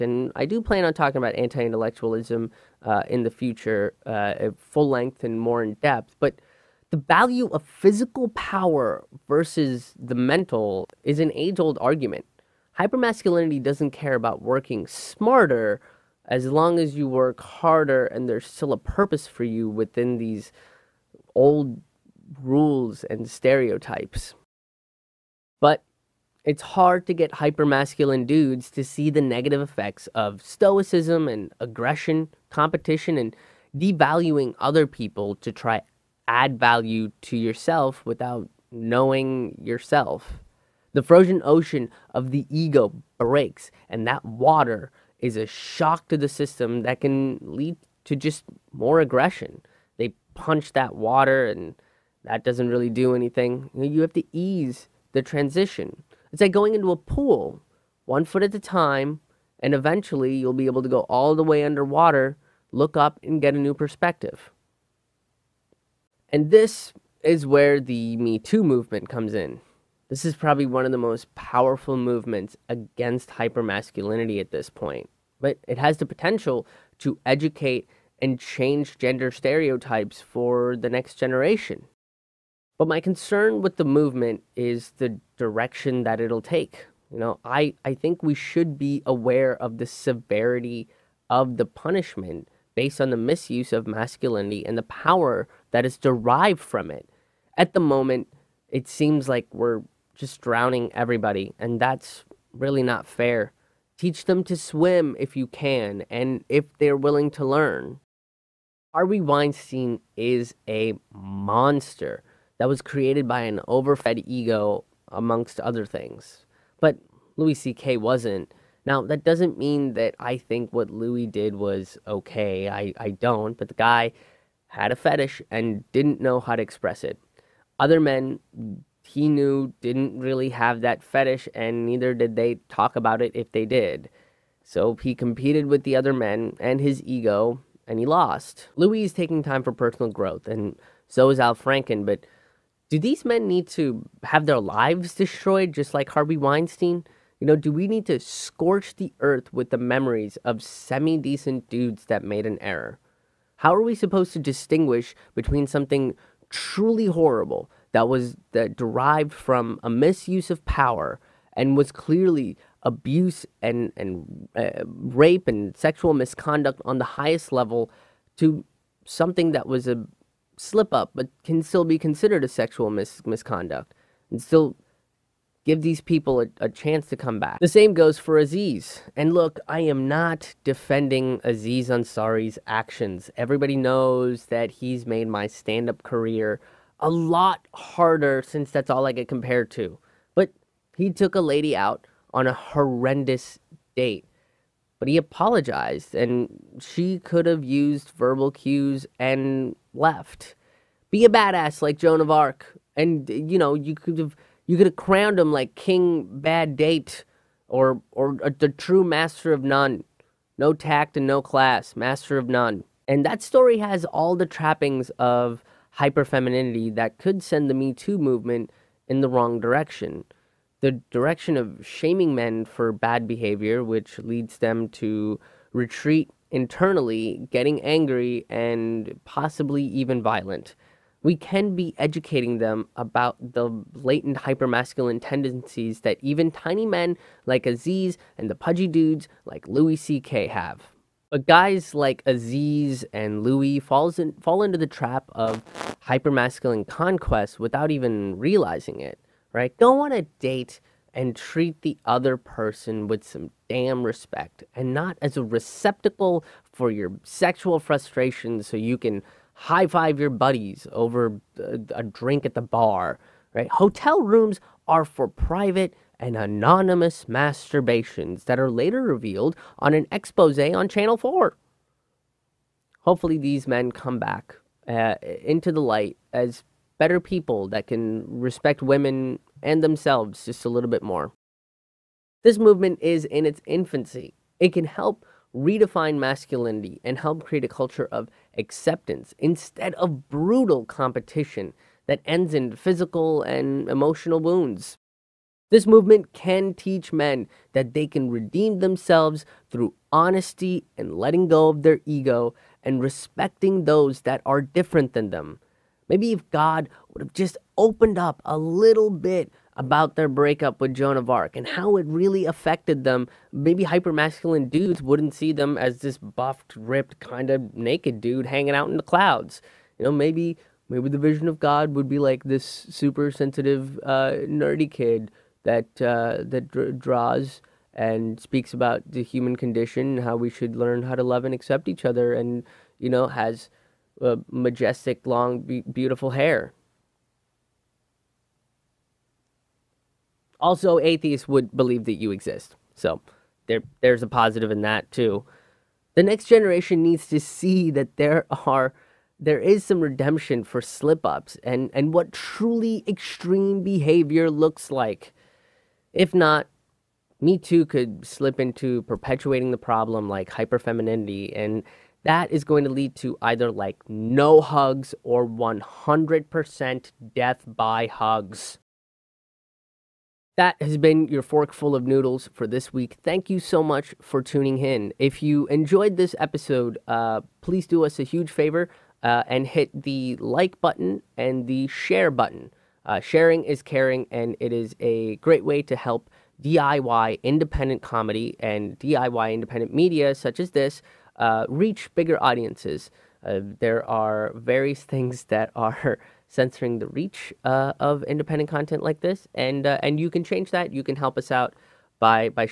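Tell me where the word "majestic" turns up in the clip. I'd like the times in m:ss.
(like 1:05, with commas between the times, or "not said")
5:34.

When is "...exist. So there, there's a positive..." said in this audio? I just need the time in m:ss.
5:42.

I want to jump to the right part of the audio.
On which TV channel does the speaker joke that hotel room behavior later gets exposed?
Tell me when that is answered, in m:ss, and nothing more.
4:30.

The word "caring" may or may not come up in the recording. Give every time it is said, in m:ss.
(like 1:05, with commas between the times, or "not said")
6:23.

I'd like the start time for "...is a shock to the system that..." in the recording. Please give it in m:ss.
0:45.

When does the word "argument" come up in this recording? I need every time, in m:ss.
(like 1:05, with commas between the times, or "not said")
0:11.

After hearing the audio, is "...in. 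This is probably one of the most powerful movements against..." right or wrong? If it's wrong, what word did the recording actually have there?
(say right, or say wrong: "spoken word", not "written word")
right.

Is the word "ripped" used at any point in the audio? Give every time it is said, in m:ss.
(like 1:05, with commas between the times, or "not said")
5:16.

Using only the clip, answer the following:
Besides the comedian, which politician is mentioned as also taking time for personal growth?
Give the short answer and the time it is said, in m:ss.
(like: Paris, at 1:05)
Al Franken, at 2:21.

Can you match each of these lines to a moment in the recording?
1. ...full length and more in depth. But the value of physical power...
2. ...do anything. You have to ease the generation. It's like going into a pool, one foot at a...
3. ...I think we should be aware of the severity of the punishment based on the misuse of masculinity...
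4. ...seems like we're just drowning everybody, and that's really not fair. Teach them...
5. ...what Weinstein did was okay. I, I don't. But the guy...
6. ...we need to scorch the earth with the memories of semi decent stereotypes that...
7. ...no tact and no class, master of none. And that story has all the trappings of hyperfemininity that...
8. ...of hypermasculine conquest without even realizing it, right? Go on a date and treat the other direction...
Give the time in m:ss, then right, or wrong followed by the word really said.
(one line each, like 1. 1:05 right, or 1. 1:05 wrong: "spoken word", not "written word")
1. 0:04 right
2. 0:52 wrong: "transition", not "generation"
3. 1:27 right
4. 1:38 right
5. 2:00 wrong: "Louis", not "Weinstein"
6. 2:27 wrong: "dudes", not "stereotypes"
7. 3:30 right
8. 4:05 wrong: "person", not "direction".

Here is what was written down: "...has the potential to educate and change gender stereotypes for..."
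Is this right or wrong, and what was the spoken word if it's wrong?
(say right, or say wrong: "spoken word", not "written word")
right.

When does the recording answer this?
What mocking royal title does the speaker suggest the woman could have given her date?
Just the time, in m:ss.
3:25.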